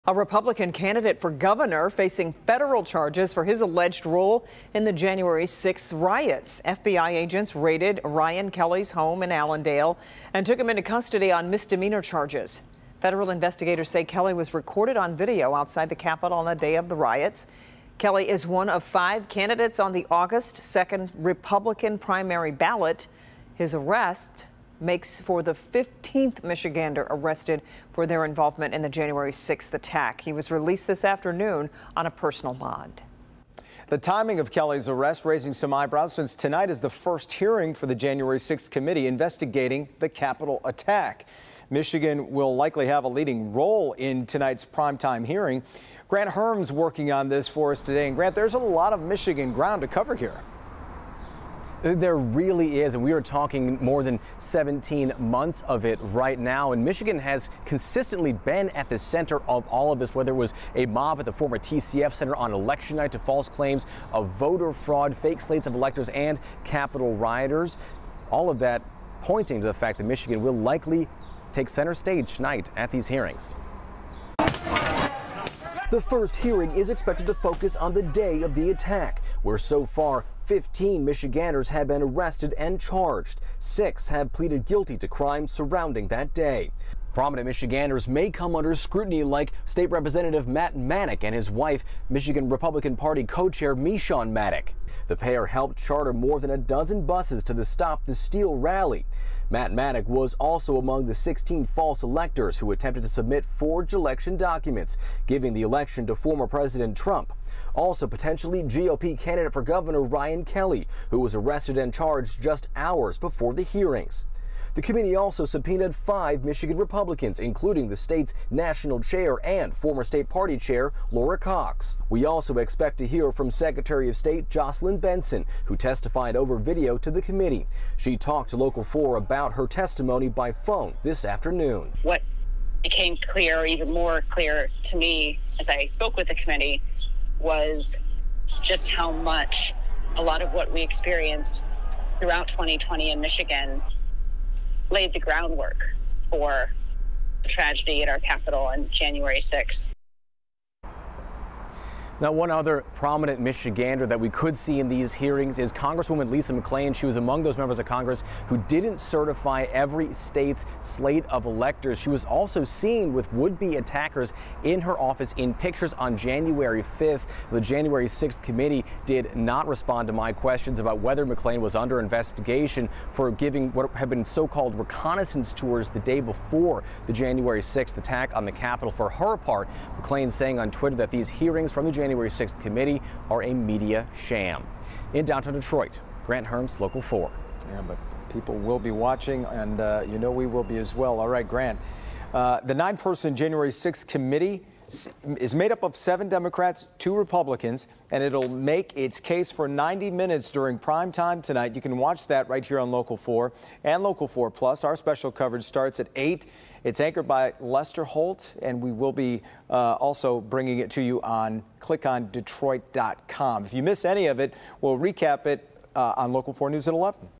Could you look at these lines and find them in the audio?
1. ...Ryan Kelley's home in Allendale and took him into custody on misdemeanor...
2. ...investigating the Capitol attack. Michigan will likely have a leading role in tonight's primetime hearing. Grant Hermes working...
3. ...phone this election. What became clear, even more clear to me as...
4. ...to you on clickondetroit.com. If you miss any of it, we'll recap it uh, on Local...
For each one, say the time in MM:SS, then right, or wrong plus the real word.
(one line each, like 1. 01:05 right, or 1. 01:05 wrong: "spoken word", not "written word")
1. 00:08 right
2. 00:39 right
3. 02:10 wrong: "afternoon", not "election"
4. 03:30 right.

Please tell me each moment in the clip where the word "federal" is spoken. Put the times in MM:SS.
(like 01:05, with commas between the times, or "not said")
00:02, 00:12.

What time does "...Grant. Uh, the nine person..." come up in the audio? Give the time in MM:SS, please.
03:11.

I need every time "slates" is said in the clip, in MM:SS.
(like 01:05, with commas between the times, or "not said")
01:05, 02:40.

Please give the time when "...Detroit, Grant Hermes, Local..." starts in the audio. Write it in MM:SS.
03:05.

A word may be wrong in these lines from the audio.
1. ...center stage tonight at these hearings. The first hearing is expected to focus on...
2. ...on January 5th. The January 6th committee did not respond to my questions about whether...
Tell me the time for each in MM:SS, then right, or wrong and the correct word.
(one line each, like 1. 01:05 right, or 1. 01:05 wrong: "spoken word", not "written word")
1. 01:11 right
2. 02:45 right.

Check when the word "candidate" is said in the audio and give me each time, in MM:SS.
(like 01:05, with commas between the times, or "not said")
00:00, 00:19, 01:49.